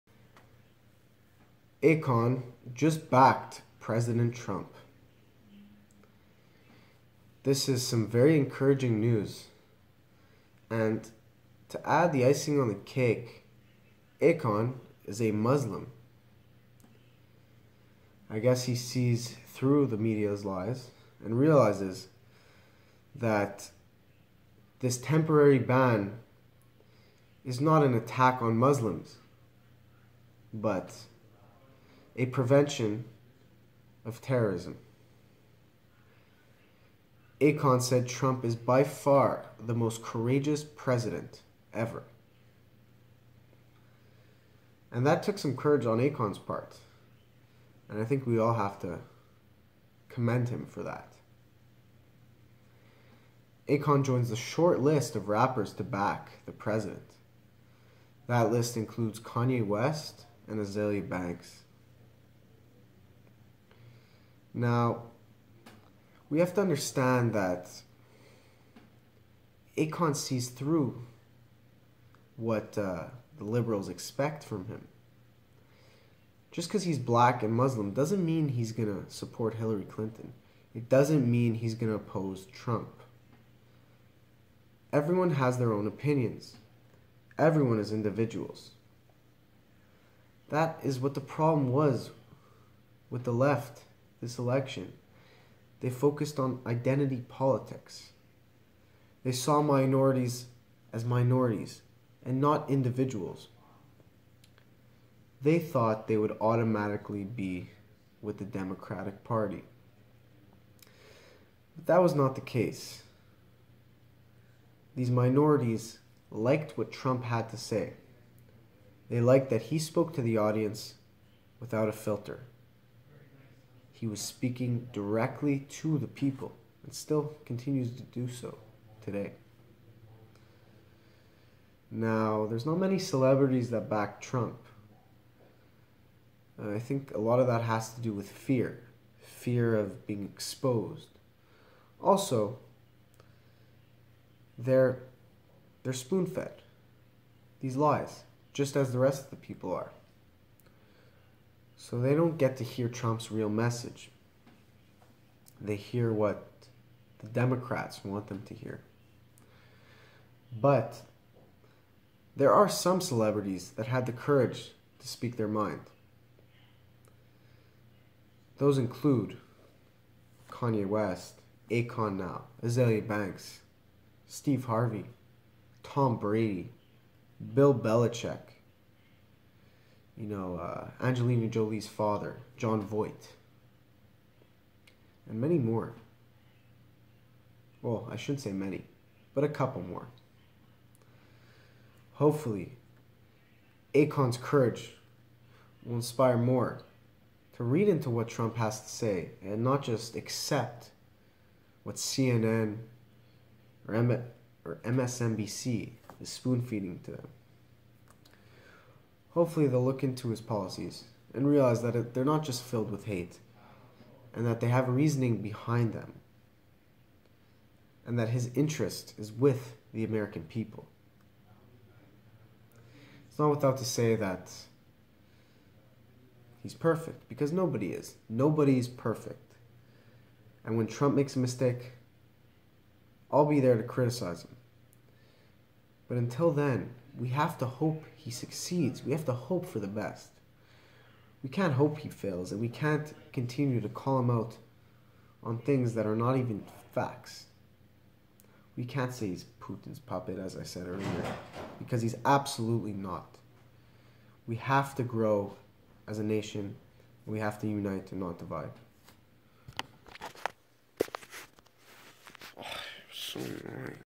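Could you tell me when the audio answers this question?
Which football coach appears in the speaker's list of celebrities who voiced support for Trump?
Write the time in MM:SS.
02:57.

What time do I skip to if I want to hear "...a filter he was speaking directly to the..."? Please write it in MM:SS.
02:01.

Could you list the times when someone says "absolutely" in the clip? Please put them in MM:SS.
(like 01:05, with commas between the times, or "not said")
04:12.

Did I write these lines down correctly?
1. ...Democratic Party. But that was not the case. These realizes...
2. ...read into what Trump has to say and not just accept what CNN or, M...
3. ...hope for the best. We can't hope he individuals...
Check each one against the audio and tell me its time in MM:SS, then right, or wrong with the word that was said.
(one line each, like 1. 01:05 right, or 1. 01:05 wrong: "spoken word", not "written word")
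1. 01:48 wrong: "minorities", not "realizes"
2. 03:17 right
3. 03:59 wrong: "fails", not "individuals".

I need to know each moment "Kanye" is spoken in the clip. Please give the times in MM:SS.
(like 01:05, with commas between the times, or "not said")
00:59, 02:50.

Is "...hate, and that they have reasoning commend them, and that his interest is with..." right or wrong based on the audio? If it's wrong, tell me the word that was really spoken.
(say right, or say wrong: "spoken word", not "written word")
wrong: "behind", not "commend".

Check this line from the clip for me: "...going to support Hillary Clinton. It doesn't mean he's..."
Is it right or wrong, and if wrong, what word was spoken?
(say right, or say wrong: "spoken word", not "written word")
right.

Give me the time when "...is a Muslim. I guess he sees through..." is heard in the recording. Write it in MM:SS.
00:15.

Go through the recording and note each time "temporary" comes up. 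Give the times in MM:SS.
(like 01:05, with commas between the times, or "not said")
00:24.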